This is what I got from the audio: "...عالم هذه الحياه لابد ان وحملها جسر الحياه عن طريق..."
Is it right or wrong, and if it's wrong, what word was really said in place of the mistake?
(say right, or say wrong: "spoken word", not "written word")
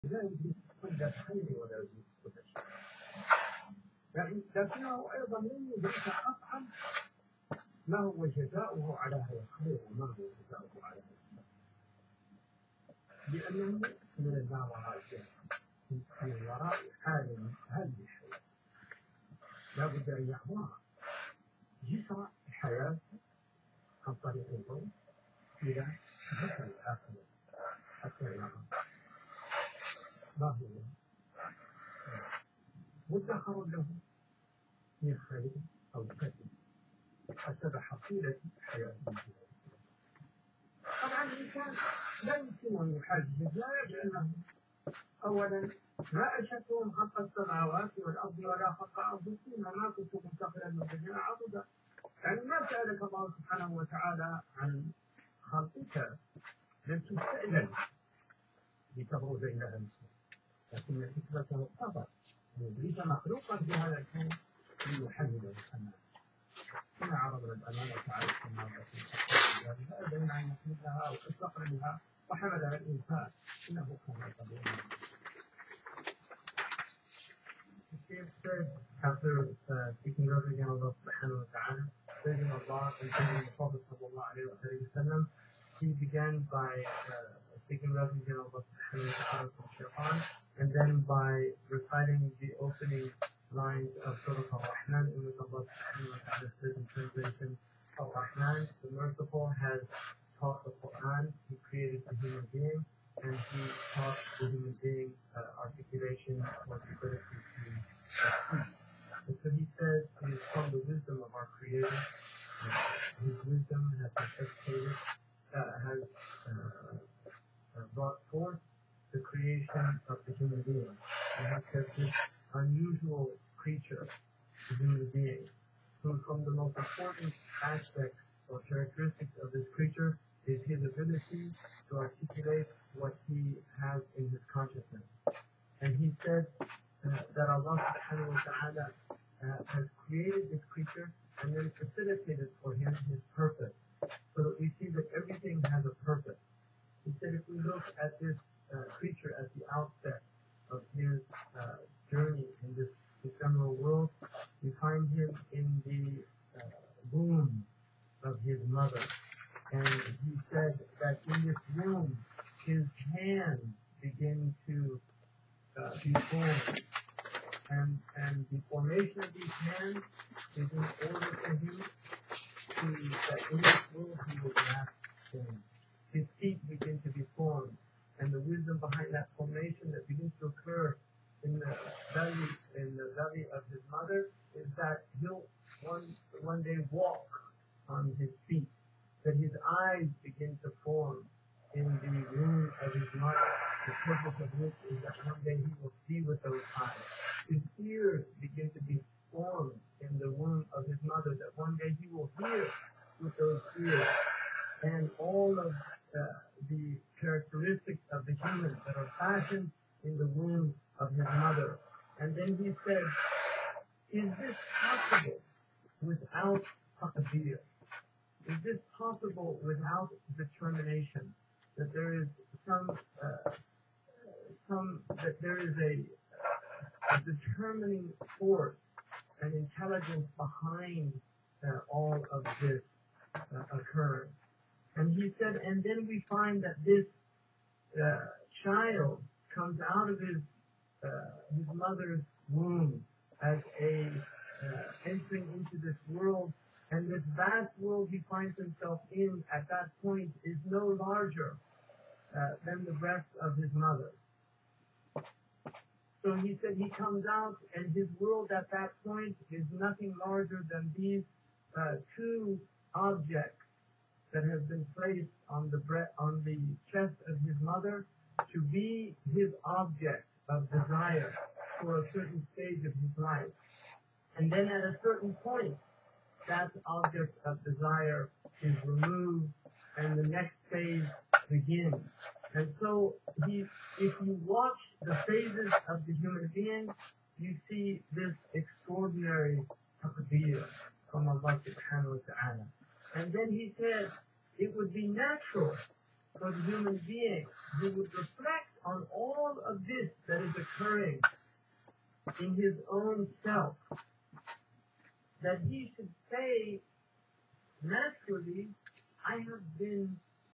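wrong: "يعبرها", not "وحملها".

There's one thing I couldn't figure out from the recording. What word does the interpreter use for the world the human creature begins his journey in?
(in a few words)
ephemeral.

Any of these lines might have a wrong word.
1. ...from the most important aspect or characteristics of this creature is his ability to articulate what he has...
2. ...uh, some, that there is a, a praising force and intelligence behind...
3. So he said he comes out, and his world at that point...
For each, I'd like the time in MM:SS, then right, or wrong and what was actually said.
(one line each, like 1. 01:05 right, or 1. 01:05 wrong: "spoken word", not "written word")
1. 02:06 right
2. 03:43 wrong: "determining", not "praising"
3. 04:16 right.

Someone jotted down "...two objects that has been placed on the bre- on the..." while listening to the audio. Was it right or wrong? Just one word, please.
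right.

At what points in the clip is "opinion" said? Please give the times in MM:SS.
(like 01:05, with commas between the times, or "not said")
not said.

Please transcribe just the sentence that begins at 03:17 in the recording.
His ears begin to be formed in the womb of his mother, that one day he will hear with those ears.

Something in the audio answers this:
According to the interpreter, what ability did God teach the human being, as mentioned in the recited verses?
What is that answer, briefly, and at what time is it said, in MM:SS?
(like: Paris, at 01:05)
articulation, at 01:45.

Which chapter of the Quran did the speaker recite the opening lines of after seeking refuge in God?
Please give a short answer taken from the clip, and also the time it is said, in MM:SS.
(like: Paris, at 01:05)
Surah Al-Rahman, at 01:34.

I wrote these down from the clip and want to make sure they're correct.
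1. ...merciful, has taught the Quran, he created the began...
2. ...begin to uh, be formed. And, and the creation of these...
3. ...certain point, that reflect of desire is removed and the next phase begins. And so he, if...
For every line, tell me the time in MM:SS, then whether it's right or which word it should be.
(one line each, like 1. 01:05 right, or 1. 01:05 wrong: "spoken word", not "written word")
1. 01:38 wrong: "human", not "began"
2. 02:44 wrong: "formation", not "creation"
3. 04:35 wrong: "object", not "reflect".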